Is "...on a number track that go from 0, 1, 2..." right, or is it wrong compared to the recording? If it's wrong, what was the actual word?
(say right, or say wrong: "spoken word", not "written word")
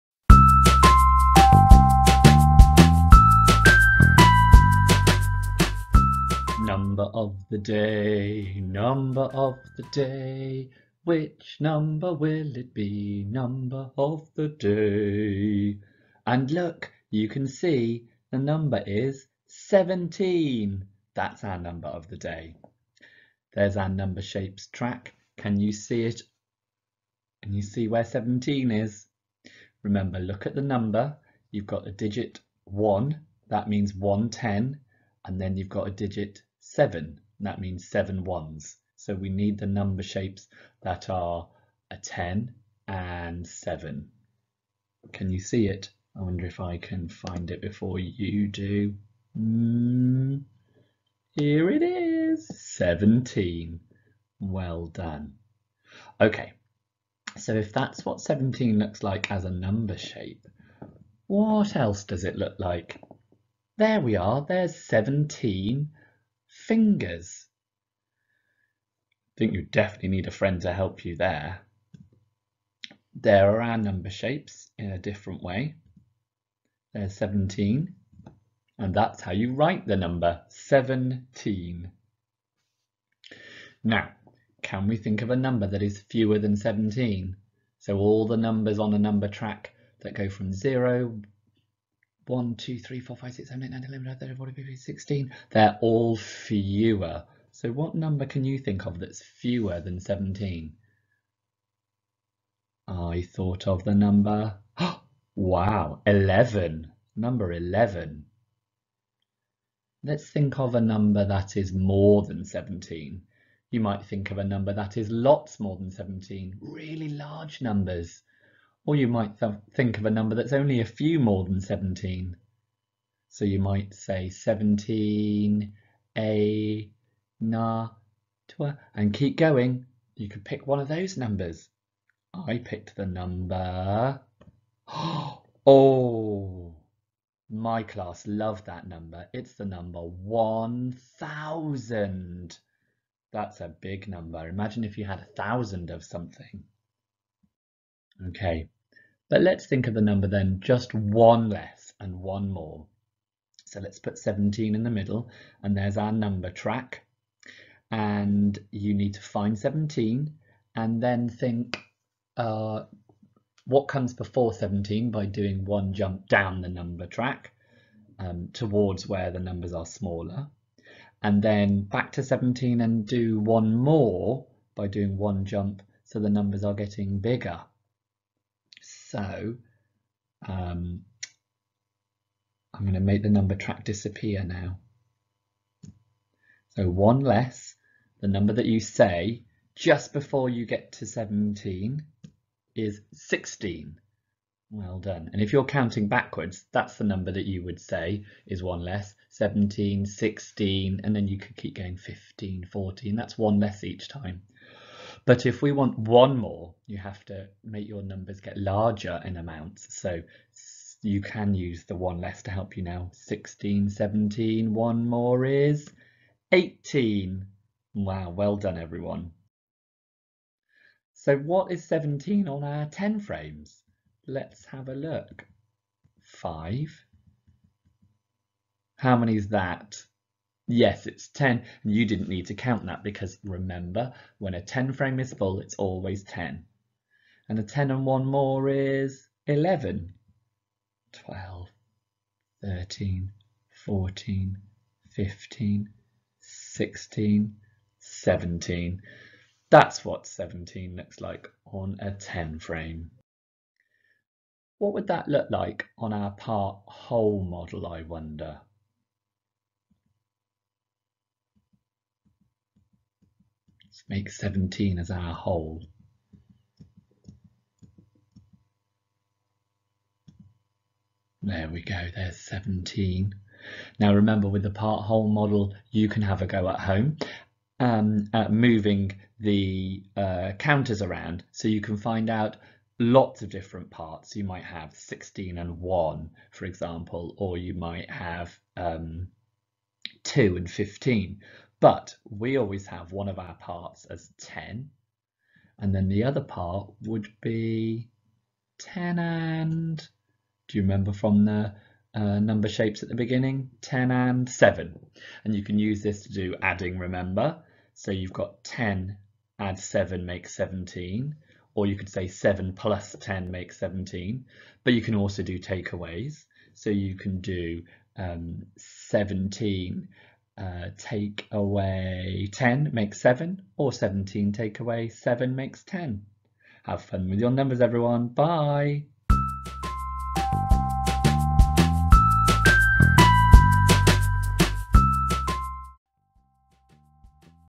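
right.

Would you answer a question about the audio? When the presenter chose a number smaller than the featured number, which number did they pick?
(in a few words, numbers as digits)
11.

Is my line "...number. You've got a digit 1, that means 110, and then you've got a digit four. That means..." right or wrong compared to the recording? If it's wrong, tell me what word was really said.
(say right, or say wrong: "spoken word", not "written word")
wrong: "seven", not "four".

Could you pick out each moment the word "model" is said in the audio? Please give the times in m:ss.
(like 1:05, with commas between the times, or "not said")
4:17, 4:35.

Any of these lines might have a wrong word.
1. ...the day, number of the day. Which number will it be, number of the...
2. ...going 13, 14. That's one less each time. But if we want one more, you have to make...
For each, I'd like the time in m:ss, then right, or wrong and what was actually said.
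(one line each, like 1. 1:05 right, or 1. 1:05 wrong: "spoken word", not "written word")
1. 0:07 right
2. 3:21 wrong: "15", not "13".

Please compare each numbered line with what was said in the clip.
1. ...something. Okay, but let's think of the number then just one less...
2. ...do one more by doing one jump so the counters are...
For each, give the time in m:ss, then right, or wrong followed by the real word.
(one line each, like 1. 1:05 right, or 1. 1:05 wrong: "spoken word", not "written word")
1. 2:26 right
2. 2:53 wrong: "numbers", not "counters".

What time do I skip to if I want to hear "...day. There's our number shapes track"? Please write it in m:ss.
0:22.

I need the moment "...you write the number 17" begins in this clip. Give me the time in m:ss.
1:19.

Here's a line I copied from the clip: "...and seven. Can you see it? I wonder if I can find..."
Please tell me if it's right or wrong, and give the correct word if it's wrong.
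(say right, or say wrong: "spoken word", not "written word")
right.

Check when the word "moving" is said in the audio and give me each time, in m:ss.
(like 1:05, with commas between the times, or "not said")
4:38.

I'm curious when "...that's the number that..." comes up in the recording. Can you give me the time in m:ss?
3:16.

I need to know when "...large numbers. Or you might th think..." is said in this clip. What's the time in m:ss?
1:57.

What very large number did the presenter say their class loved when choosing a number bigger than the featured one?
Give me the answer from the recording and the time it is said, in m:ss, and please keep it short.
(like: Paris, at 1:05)
1000, at 2:20.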